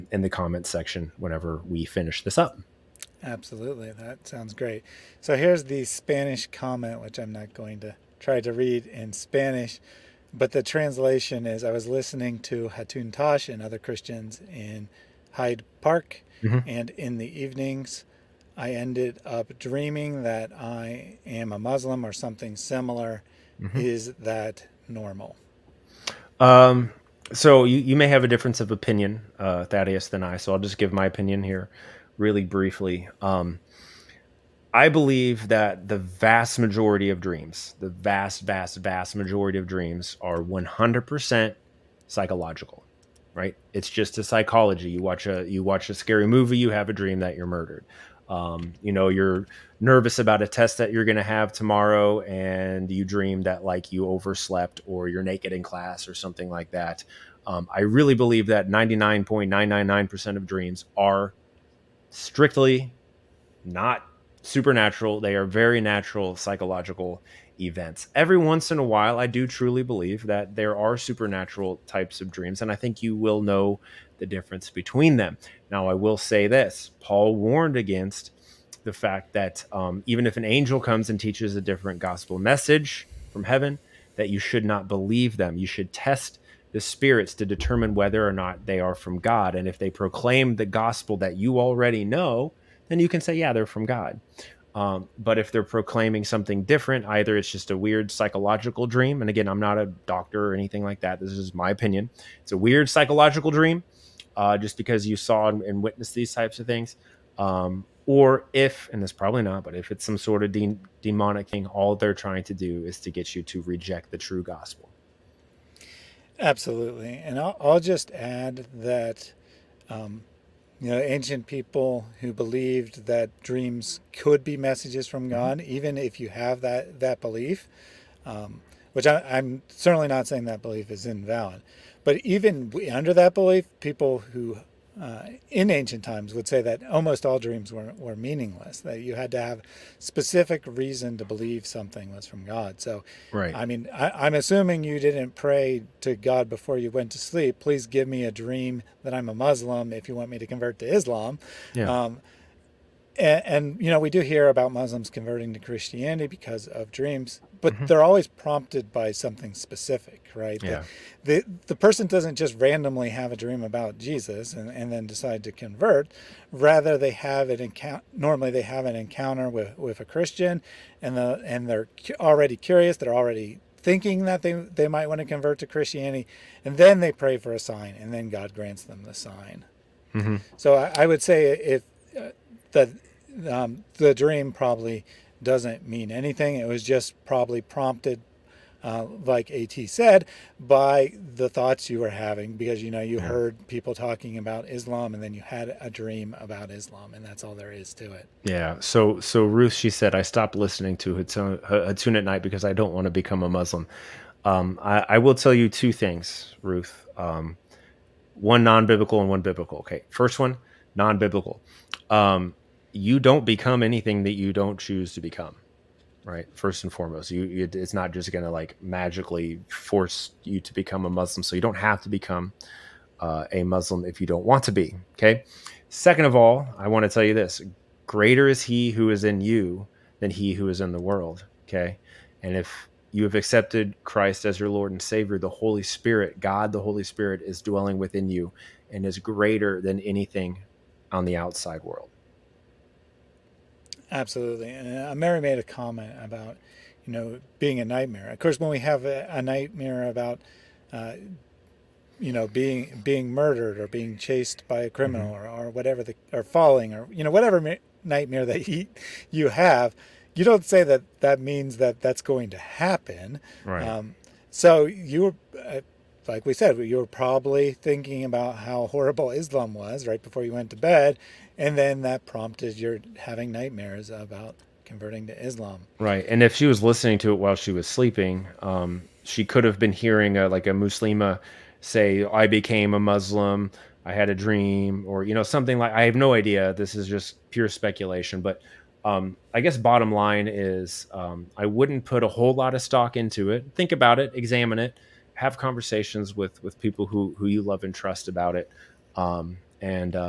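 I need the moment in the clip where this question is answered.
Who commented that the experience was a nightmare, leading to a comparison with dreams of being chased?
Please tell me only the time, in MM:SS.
04:05.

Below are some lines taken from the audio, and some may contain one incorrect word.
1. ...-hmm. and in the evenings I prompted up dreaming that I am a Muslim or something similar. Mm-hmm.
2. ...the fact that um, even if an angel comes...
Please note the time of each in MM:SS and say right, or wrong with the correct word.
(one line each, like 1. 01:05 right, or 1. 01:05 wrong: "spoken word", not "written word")
1. 00:16 wrong: "ended", not "prompted"
2. 01:18 right.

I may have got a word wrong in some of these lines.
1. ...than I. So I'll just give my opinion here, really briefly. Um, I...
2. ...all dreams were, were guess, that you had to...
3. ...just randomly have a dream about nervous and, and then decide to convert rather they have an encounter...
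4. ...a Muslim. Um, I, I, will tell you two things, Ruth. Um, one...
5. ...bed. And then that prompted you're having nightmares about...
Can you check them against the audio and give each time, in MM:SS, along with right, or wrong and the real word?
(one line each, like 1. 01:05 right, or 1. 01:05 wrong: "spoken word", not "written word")
1. 00:30 right
2. 02:17 wrong: "meaningless", not "guess"
3. 02:42 wrong: "jesus", not "nervous"
4. 03:23 right
5. 04:30 right.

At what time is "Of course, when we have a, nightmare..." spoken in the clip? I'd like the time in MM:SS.
04:08.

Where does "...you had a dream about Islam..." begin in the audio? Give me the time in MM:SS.
03:15.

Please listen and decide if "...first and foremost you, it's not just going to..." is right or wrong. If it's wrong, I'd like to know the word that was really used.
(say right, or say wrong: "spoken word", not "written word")
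right.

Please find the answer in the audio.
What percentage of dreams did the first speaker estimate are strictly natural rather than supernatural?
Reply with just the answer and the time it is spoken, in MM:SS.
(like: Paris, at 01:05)
99.999%, at 00:58.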